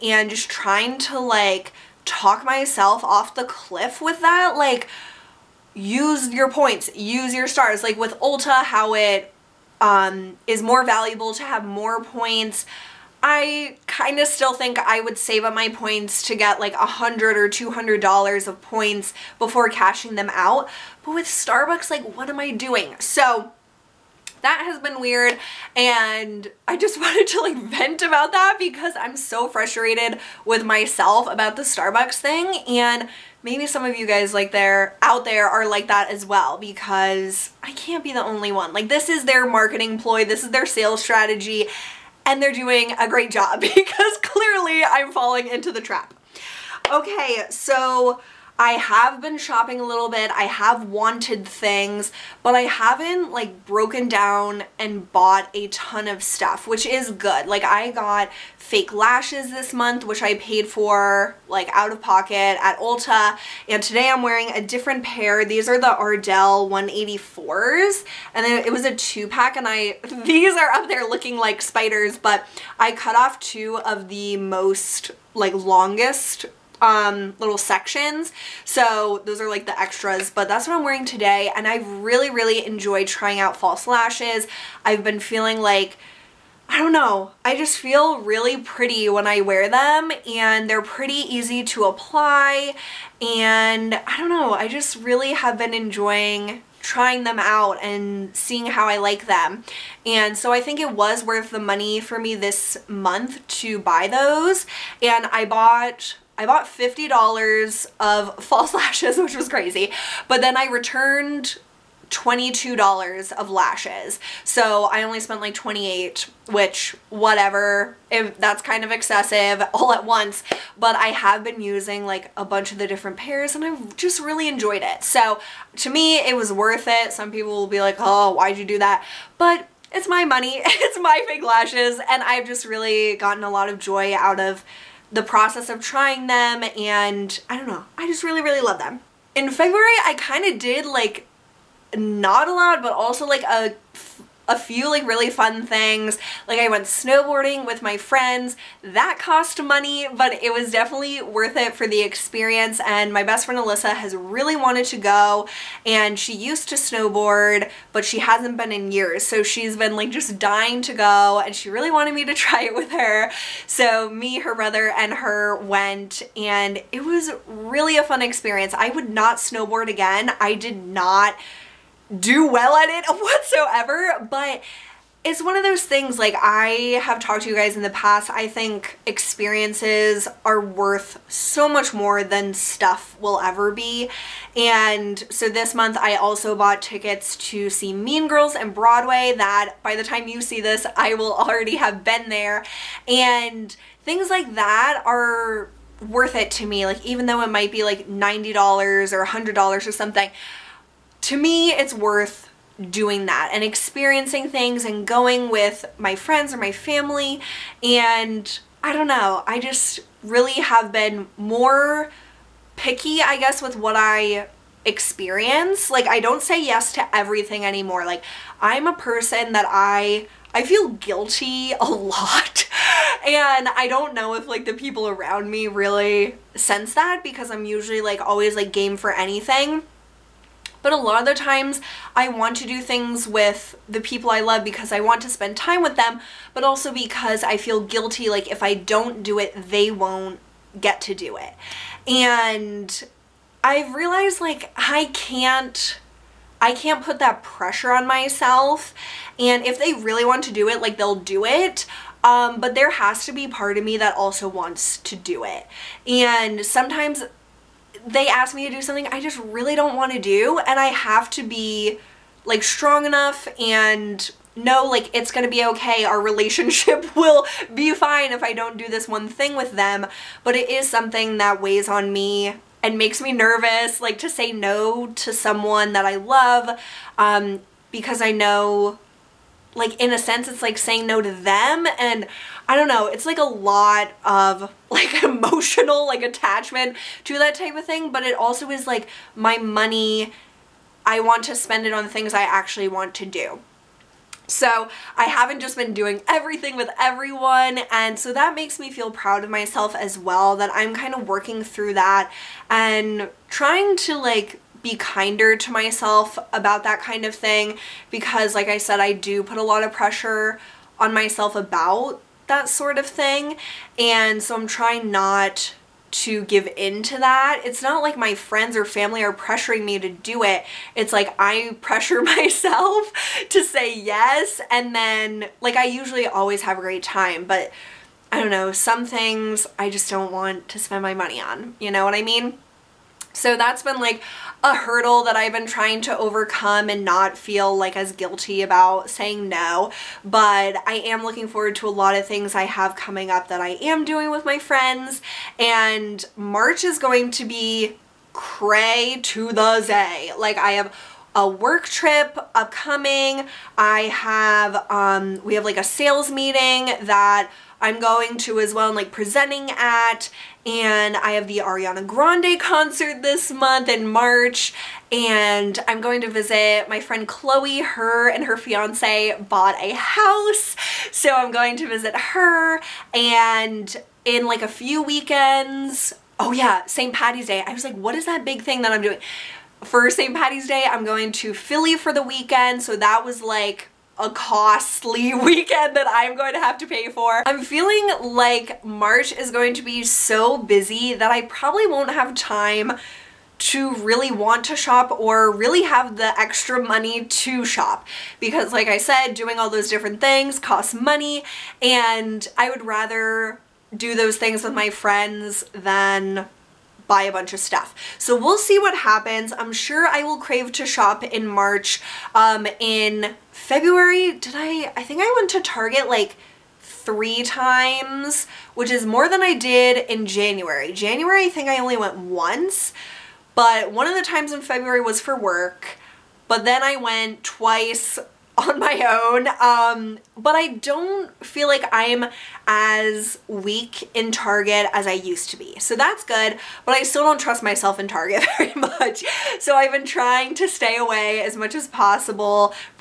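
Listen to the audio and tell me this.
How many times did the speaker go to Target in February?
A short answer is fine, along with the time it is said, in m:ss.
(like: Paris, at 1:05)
3, at 6:56.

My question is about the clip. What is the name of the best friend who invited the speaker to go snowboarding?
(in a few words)
Alyssa.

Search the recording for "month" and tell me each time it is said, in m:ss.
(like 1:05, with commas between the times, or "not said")
0:59, 1:42, 3:05, 6:03.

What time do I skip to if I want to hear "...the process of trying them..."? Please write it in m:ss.
2:15.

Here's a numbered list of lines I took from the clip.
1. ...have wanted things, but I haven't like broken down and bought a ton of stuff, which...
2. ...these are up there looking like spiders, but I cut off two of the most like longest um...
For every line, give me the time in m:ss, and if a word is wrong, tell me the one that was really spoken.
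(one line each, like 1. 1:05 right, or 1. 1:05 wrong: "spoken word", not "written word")
1. 0:50 right
2. 1:10 right.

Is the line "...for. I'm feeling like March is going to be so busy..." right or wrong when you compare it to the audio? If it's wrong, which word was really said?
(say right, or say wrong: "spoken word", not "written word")
right.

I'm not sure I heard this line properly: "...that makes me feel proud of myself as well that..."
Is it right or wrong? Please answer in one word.
right.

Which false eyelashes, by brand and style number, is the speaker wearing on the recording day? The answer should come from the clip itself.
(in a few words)
Ardell 184.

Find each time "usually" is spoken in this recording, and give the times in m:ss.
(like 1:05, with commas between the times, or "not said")
3:47, 5:25.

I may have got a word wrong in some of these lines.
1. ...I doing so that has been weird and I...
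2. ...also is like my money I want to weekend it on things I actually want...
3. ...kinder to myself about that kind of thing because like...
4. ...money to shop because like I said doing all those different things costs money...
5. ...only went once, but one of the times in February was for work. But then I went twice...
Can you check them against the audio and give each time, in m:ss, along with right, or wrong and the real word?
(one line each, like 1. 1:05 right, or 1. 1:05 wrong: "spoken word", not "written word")
1. 0:22 right
2. 4:48 wrong: "spend", not "weekend"
3. 5:04 right
4. 6:36 right
5. 7:01 right.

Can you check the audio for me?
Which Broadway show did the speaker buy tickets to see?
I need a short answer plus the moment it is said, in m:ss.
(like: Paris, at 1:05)
Mean Girls, at 3:07.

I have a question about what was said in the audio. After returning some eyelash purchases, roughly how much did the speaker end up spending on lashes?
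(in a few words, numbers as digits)
$28.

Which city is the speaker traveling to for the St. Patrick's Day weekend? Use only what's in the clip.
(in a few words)
Philly.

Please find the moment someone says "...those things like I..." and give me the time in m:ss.
2:55.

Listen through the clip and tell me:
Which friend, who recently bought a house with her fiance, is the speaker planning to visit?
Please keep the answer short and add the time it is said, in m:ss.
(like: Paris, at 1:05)
Chloe, at 6:07.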